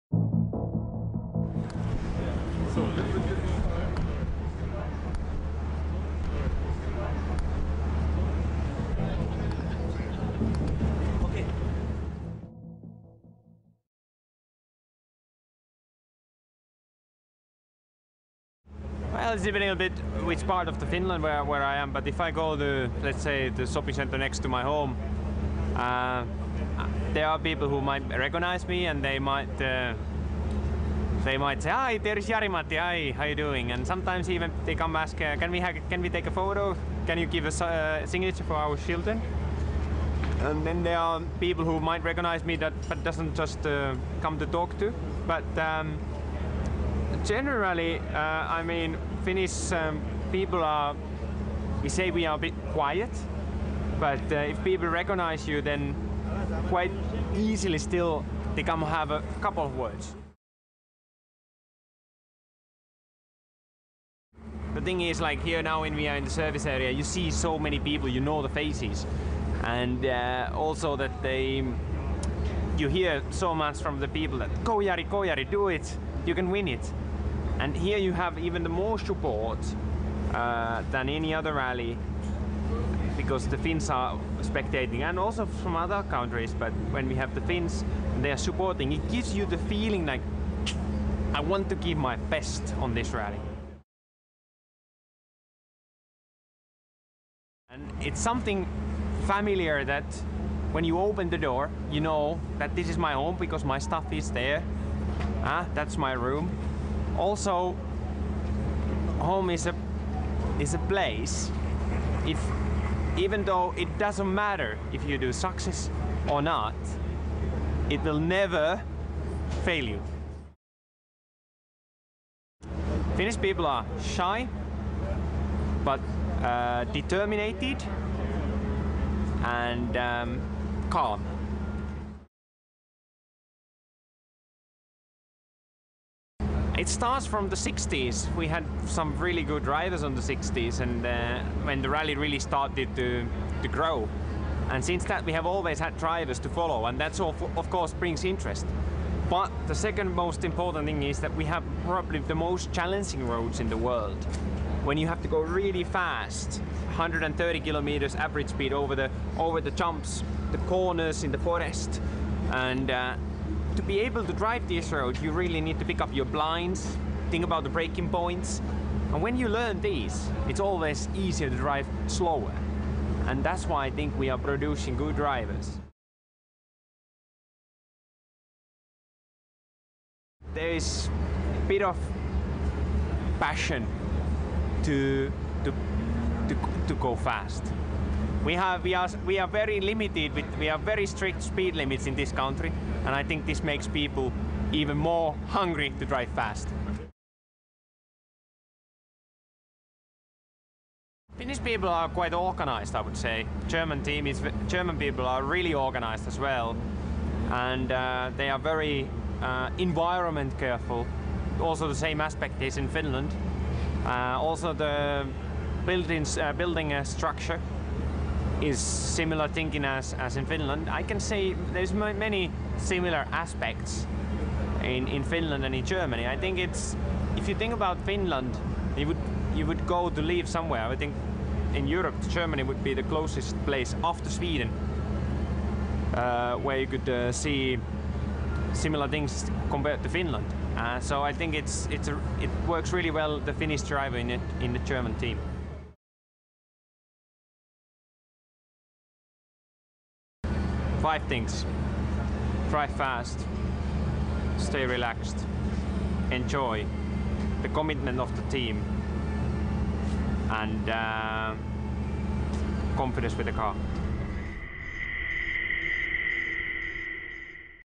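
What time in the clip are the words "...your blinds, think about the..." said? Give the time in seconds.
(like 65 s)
166 s.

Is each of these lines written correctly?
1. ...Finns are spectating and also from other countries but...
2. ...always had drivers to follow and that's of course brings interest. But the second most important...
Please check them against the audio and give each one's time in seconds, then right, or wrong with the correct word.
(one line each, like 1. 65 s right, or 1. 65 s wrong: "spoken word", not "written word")
1. 83 s right
2. 145 s right.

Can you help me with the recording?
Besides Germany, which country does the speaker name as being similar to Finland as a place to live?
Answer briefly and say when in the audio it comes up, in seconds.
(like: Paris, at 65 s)
Sweden, at 234 s.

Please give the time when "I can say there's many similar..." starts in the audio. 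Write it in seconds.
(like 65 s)
220 s.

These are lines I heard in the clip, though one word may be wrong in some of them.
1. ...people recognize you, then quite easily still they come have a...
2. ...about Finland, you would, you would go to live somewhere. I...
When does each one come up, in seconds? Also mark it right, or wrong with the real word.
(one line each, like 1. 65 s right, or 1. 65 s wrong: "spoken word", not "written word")
1. 54 s right
2. 227 s right.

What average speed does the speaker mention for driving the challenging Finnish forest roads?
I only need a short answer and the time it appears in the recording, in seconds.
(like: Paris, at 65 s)
130 km/h, at 156 s.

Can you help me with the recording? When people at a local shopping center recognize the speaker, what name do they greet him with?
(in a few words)
Jari-Matti.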